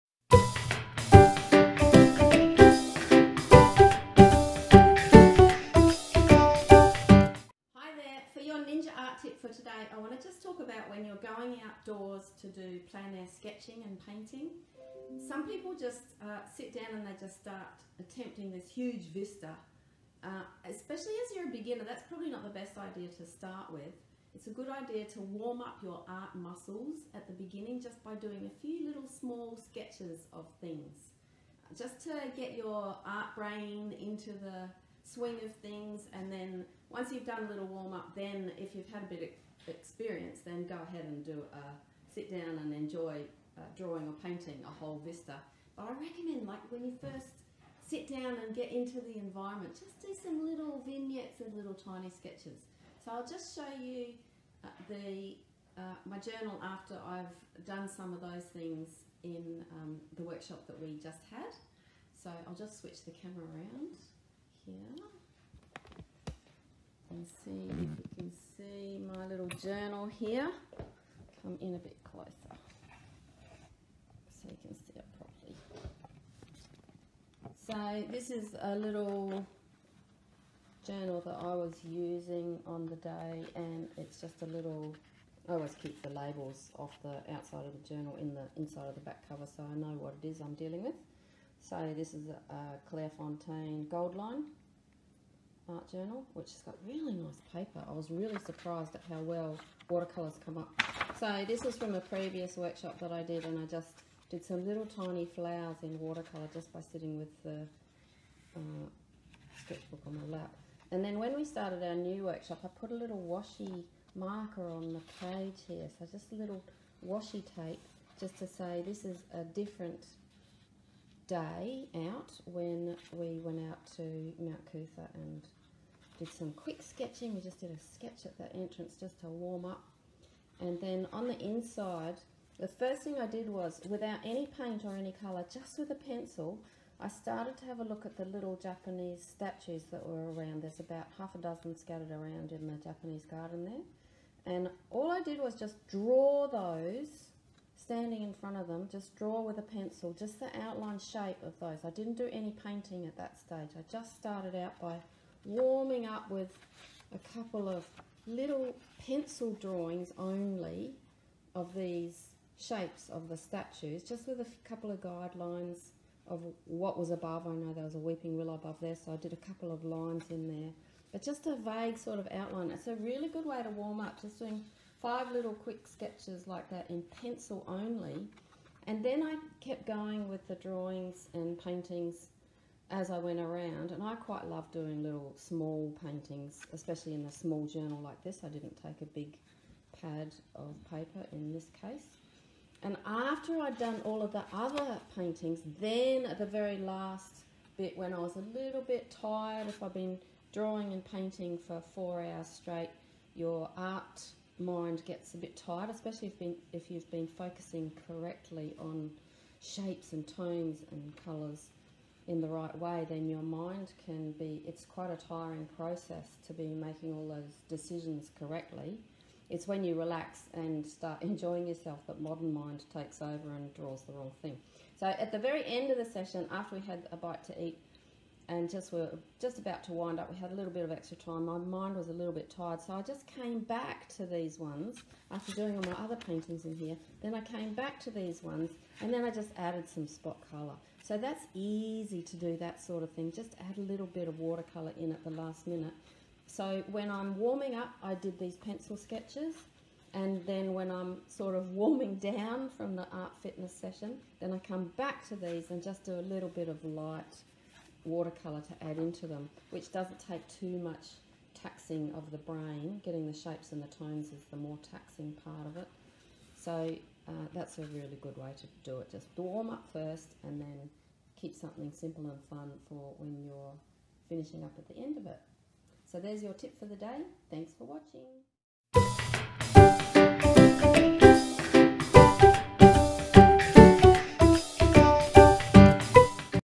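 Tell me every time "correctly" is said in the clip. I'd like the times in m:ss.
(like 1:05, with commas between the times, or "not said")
3:28, 3:38.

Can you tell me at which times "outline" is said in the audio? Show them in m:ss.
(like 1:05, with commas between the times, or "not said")
2:30, 2:52.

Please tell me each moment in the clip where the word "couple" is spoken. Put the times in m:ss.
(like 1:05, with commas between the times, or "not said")
2:37, 2:44, 2:49.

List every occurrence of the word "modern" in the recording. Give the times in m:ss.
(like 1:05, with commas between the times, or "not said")
3:42.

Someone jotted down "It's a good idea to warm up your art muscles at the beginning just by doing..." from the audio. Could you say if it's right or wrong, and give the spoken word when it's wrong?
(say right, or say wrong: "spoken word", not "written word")
right.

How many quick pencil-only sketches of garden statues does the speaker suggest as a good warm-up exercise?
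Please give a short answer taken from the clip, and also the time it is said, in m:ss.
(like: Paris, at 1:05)
5, at 2:55.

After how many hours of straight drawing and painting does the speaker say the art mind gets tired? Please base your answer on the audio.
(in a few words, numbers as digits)
4.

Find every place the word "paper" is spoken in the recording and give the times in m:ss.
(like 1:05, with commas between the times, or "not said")
1:37, 3:10.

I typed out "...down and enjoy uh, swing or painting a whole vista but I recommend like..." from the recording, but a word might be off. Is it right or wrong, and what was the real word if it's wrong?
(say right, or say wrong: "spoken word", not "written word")
wrong: "drawing", not "swing".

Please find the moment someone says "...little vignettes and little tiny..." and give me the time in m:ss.
0:50.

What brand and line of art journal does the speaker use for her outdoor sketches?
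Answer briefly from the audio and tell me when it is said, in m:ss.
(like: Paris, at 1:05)
Clairefontaine Gold Line, at 1:32.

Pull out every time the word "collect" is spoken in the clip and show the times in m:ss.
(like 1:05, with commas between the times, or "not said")
not said.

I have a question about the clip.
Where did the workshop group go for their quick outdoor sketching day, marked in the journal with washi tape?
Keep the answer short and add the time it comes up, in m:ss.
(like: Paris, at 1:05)
Mount Coot-tha, at 2:04.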